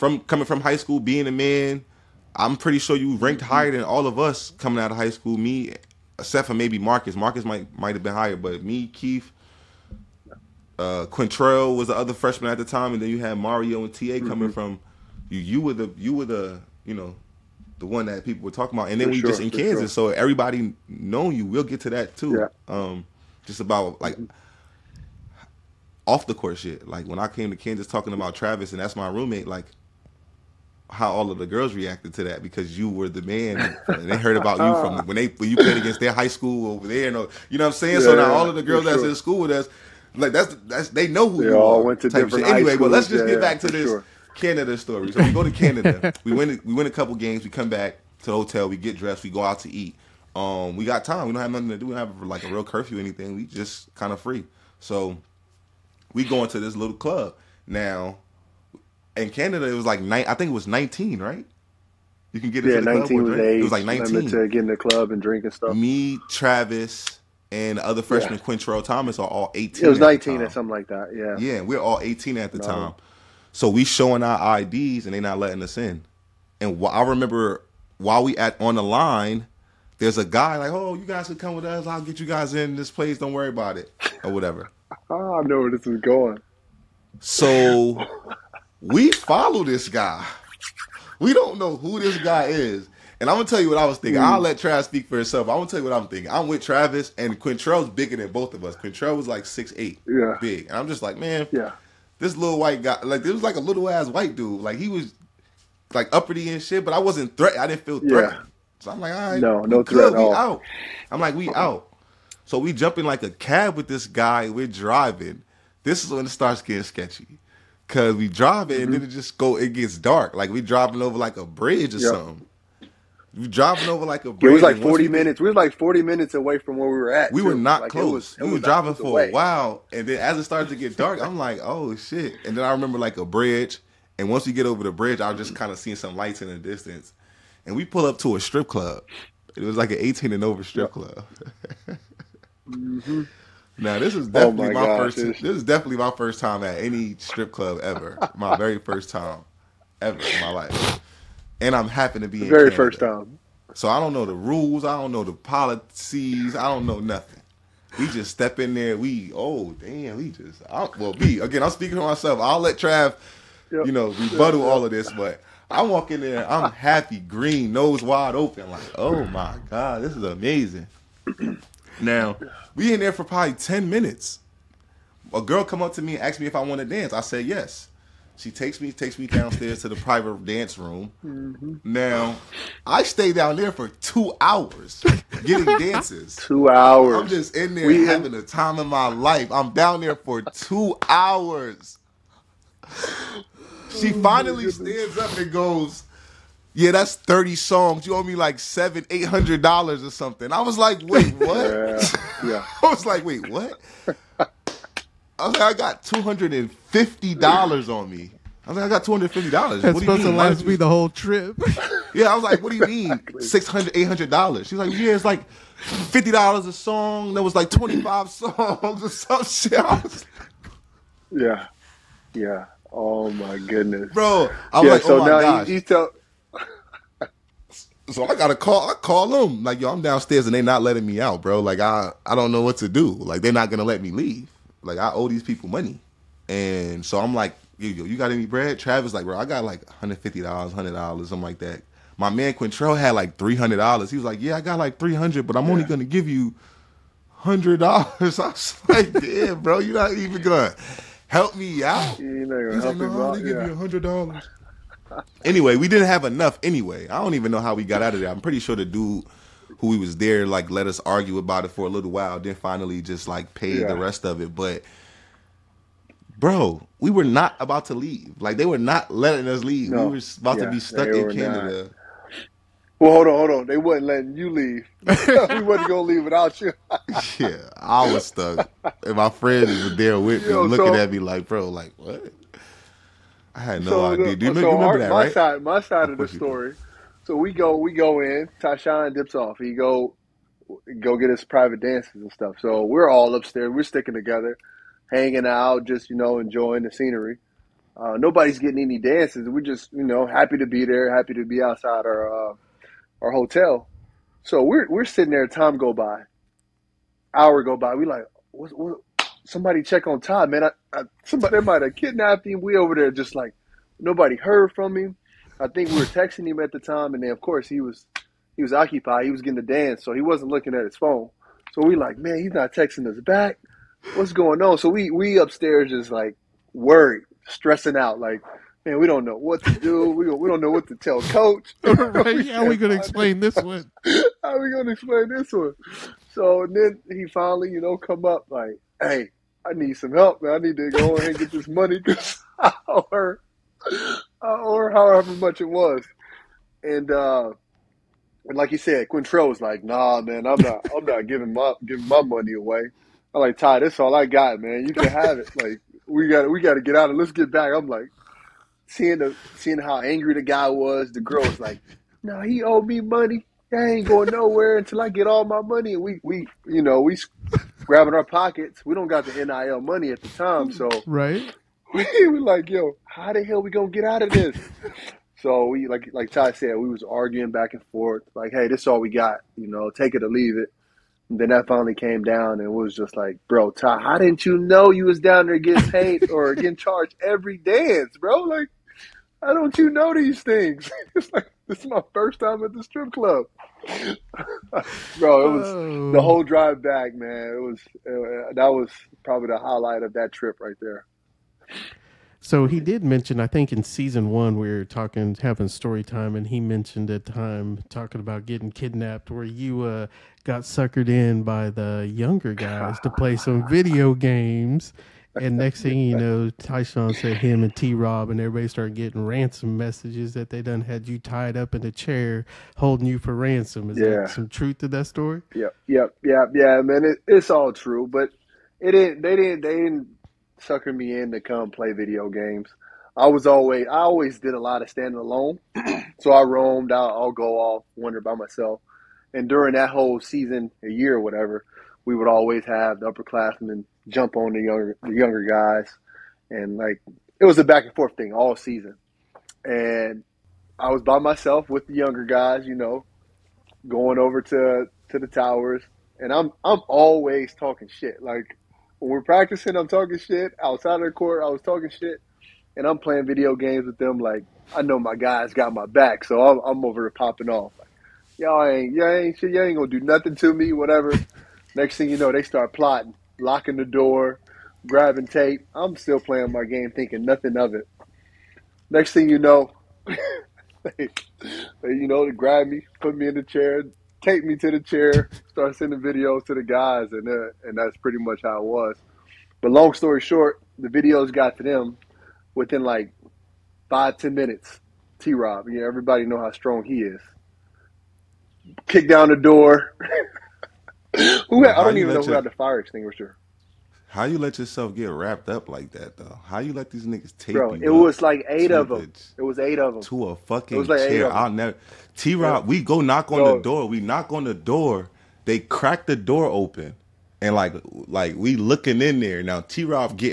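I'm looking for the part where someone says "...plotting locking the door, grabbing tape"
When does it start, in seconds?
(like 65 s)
472 s.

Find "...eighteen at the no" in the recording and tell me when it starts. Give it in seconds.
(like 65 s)
72 s.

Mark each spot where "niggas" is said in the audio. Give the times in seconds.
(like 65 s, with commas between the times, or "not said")
507 s.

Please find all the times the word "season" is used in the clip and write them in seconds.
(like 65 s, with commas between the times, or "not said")
403 s, 440 s, 448 s.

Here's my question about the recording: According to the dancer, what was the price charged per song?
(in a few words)
$50.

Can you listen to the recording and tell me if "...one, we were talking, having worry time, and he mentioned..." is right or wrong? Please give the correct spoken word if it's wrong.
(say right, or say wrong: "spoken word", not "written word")
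wrong: "story", not "worry".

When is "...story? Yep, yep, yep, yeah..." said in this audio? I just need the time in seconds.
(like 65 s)
425 s.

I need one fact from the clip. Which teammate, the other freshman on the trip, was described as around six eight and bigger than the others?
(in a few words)
Quintrell Thomas.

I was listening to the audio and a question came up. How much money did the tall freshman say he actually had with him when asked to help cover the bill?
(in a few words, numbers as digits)
$300.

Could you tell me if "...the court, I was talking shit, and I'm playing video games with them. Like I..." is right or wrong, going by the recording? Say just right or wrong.
right.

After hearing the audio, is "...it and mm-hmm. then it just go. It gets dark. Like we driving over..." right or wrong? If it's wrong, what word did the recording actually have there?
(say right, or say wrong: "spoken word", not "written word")
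right.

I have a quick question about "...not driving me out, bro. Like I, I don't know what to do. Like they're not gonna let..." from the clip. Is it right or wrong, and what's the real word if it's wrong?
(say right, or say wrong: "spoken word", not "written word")
wrong: "letting", not "driving".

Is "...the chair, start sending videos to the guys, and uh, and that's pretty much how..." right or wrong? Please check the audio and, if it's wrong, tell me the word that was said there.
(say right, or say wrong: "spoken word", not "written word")
right.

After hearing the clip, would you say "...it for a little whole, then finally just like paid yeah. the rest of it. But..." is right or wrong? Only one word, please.
wrong.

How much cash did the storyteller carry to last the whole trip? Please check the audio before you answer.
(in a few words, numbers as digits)
$250.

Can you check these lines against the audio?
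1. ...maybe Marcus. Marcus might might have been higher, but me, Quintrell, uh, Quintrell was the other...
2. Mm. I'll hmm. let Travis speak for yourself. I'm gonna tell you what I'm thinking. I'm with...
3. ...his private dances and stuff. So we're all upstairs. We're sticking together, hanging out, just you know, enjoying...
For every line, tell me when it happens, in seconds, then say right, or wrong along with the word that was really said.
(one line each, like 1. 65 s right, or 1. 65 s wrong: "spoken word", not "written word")
1. 6 s wrong: "Keith", not "Quintrell"
2. 94 s wrong: "himself", not "yourself"
3. 291 s right.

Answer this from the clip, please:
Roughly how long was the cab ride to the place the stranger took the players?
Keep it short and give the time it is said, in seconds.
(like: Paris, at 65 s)
40 minutes, at 124 s.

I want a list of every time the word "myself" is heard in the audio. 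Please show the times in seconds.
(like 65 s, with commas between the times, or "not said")
162 s, 438 s, 451 s.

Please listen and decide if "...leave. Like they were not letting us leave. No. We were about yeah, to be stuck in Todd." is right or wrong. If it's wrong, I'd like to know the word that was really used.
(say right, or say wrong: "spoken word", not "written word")
wrong: "Canada", not "Todd".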